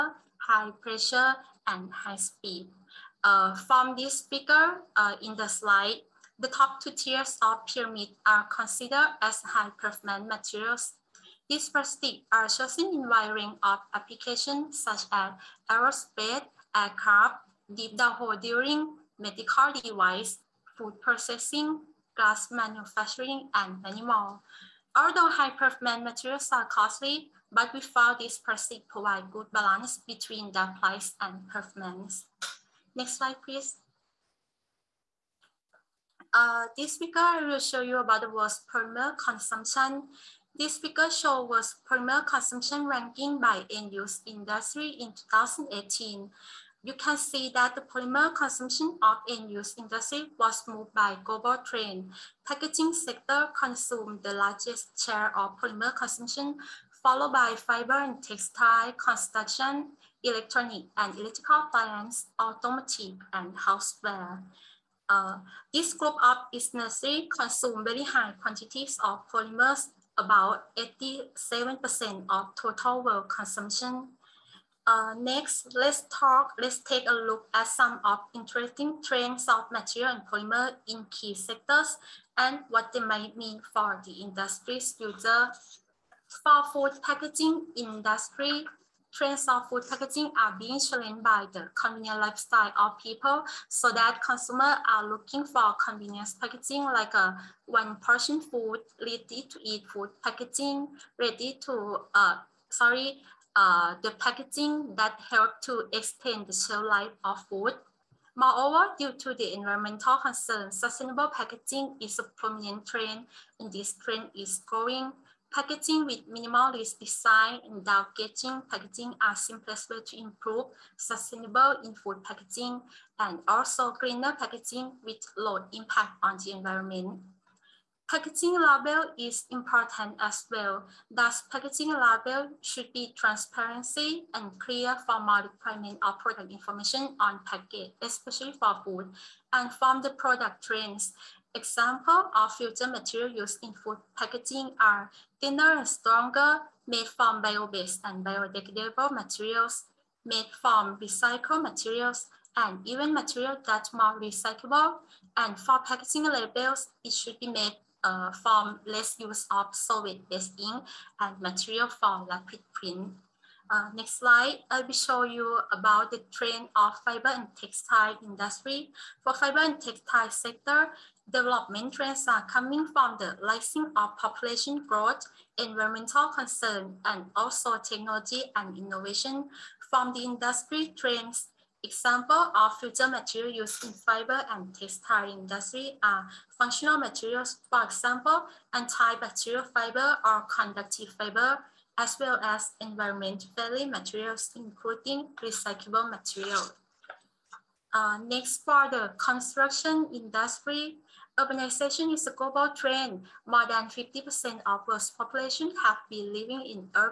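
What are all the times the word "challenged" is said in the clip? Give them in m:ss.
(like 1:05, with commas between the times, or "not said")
1:30.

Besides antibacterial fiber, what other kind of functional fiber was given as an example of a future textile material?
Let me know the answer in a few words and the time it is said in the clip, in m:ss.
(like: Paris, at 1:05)
Conductive fiber, at 3:10.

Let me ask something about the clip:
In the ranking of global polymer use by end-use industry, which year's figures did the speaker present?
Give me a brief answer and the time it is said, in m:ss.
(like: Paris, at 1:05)
2018, at 0:45.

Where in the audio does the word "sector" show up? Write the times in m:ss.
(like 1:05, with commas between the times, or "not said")
0:52, 1:21, 2:50.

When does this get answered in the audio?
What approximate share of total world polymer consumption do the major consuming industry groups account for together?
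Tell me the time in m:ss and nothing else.
1:10.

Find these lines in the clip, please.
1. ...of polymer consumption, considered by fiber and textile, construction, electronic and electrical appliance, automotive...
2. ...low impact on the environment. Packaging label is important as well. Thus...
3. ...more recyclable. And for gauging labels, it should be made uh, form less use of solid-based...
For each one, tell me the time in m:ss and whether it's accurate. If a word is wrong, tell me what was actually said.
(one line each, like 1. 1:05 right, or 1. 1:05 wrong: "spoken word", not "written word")
1. 0:55 wrong: "followed", not "considered"
2. 2:05 right
3. 2:33 wrong: "packaging", not "gauging".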